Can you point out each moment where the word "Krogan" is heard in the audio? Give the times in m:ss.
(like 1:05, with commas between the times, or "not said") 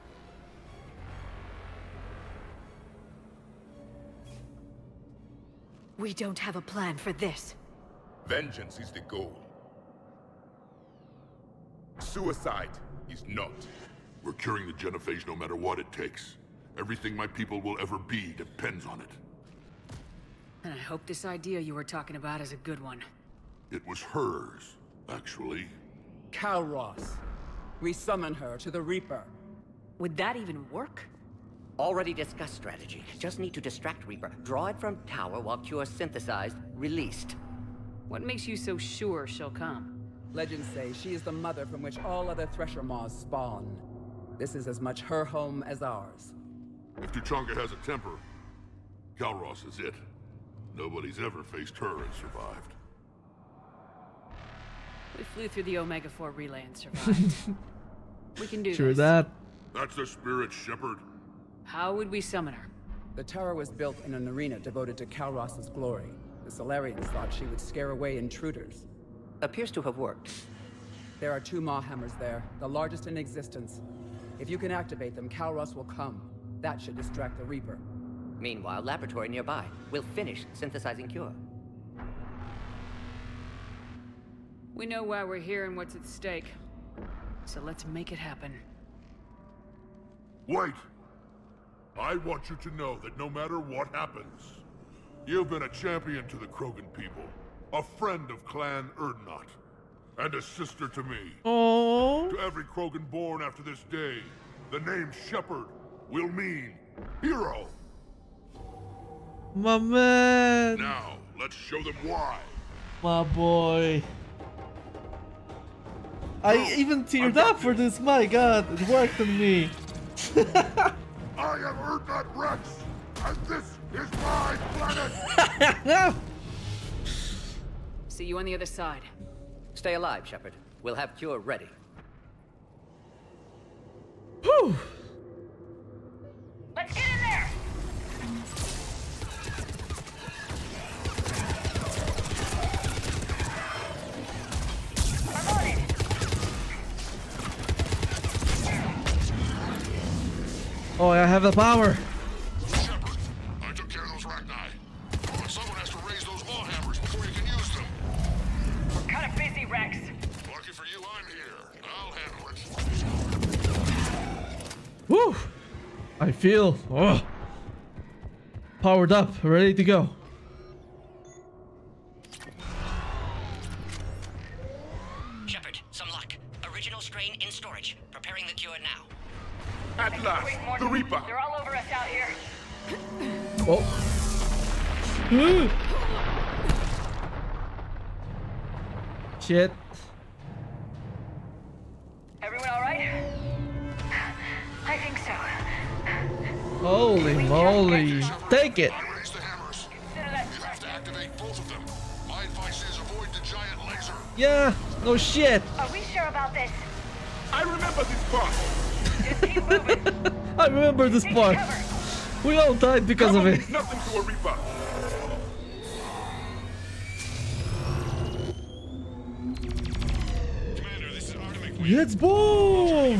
1:36, 1:42.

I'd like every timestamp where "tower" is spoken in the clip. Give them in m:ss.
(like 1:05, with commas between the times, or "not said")
0:35, 1:03.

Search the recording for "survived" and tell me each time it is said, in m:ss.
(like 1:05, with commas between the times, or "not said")
0:52, 0:56.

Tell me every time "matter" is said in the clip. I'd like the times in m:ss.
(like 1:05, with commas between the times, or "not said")
0:15, 1:33.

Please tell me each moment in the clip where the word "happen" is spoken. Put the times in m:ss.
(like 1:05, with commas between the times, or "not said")
1:28, 1:33.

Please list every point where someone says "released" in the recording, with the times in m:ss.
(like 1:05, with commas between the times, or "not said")
0:36.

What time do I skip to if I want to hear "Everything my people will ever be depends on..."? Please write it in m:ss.
0:16.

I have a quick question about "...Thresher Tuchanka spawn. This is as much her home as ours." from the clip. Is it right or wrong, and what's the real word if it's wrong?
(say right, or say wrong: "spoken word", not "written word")
wrong: "Maws", not "Tuchanka".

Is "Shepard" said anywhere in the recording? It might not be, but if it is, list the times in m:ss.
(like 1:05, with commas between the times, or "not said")
1:00, 1:45, 2:10, 2:55.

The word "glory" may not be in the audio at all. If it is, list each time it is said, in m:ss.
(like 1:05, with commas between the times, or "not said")
1:05.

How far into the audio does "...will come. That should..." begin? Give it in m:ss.
1:15.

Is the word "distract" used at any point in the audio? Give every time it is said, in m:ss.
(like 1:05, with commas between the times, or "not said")
0:33, 1:16.